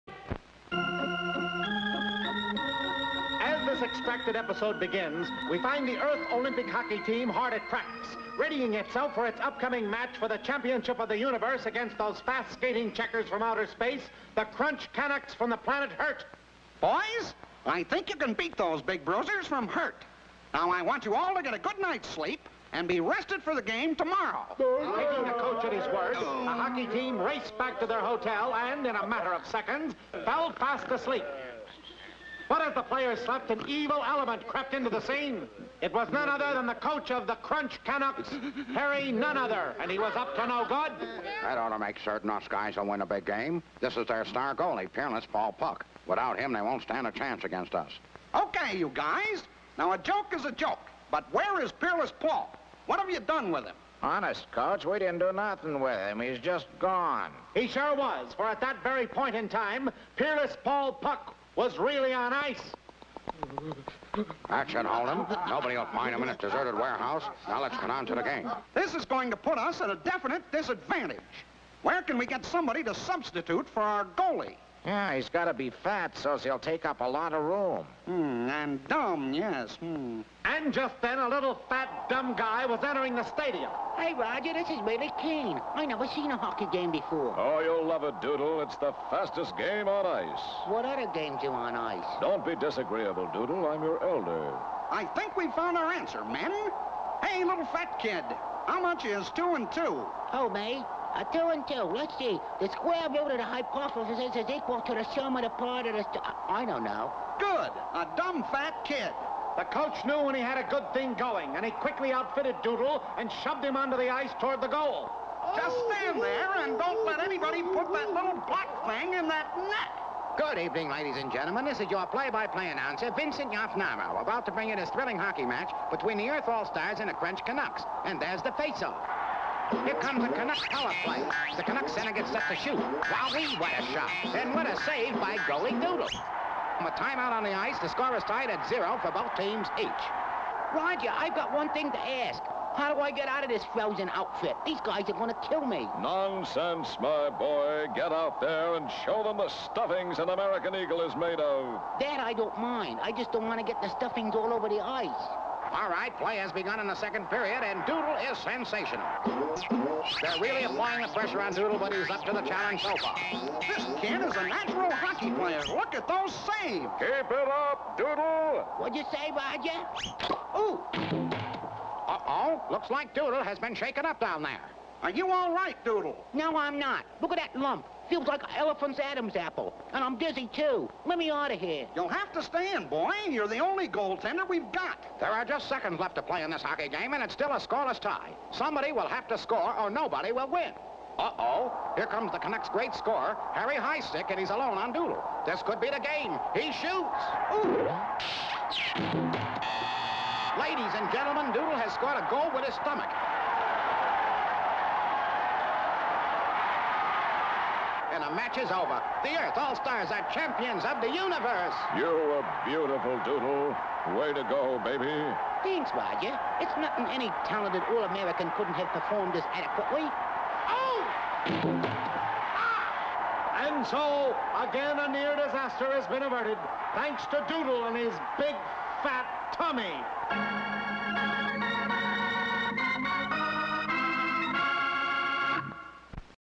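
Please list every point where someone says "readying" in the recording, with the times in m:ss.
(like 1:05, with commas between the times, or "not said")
0:08.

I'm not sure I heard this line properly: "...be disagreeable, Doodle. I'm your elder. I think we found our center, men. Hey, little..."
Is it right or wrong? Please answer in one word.
wrong.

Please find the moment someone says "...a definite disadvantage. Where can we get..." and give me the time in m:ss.
1:09.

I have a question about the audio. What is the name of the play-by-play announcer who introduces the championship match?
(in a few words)
Vincent Yafnama.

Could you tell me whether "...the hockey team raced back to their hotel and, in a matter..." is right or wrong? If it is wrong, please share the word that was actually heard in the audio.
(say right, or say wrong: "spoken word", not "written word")
right.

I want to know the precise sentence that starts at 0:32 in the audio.
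What if the players slept and evil element crept into the scene?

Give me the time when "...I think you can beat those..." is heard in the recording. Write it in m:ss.
0:17.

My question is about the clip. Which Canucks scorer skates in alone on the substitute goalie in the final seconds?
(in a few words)
Harry Highstick.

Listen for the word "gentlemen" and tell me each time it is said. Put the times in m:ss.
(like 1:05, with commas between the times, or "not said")
2:01, 3:21.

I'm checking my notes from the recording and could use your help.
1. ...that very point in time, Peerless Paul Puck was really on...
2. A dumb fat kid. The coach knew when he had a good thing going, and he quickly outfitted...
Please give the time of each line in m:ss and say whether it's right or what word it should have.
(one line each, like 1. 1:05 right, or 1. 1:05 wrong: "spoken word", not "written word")
1. 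0:58 right
2. 1:47 right.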